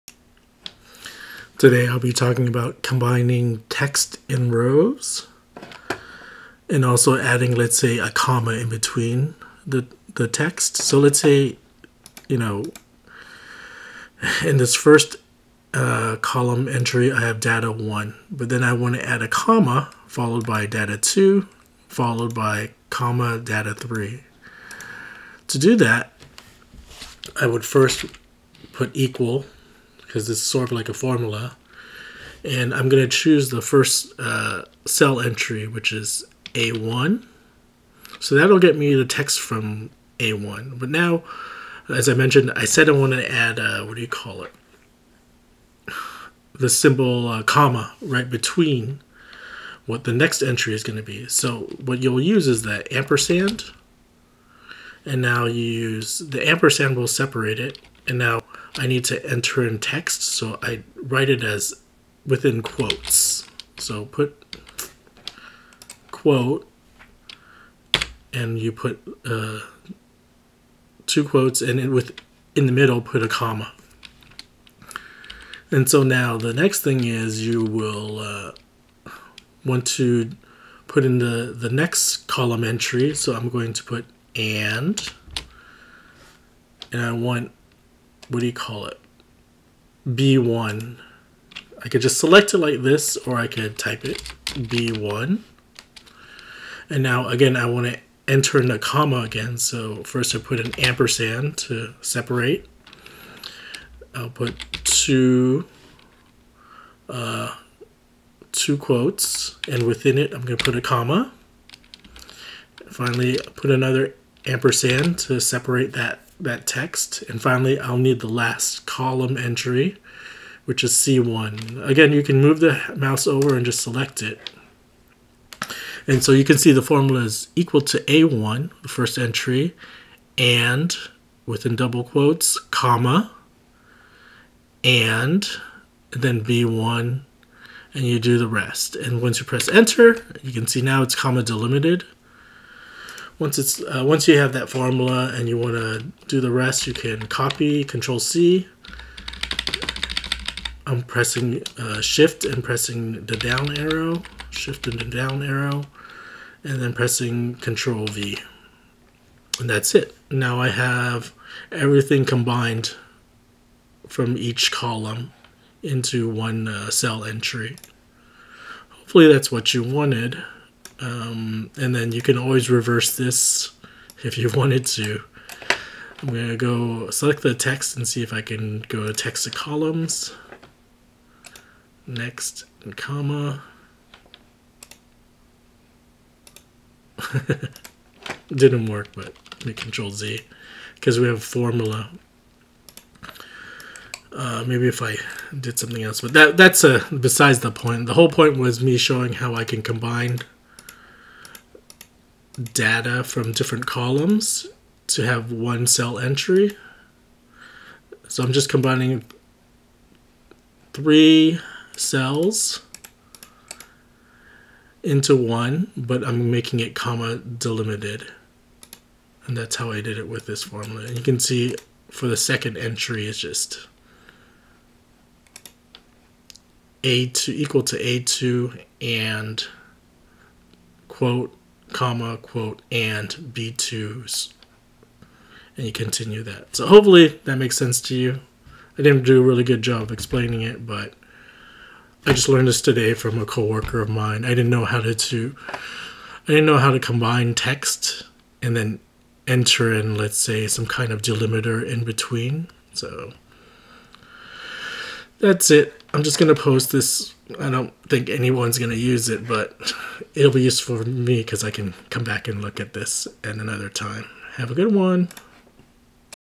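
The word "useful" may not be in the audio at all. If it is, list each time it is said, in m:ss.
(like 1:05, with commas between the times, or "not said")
4:20.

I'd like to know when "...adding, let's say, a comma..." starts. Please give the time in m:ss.
0:07.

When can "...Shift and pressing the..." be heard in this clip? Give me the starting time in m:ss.
2:32.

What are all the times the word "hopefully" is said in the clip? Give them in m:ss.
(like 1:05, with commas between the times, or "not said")
2:48, 3:56.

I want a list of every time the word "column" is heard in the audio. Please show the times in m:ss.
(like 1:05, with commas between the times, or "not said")
0:16, 1:22, 1:58, 2:44, 2:59, 3:23.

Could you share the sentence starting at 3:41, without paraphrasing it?
And you can see for the second entry, it's just a2 equal to a2 and quote comma, quote, and B2s.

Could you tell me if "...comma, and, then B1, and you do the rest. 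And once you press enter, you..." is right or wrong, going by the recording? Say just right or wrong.
right.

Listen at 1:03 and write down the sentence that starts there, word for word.
So put quote, and you put uh, two quotes, and in, with, in the middle put a comma.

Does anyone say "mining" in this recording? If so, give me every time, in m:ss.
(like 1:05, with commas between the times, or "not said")
not said.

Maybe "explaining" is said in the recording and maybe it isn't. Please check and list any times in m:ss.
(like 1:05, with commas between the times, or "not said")
4:00.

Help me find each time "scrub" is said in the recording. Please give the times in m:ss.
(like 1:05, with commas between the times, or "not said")
not said.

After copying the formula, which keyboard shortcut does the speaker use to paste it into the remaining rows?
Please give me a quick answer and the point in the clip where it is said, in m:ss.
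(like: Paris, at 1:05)
Control V, at 2:37.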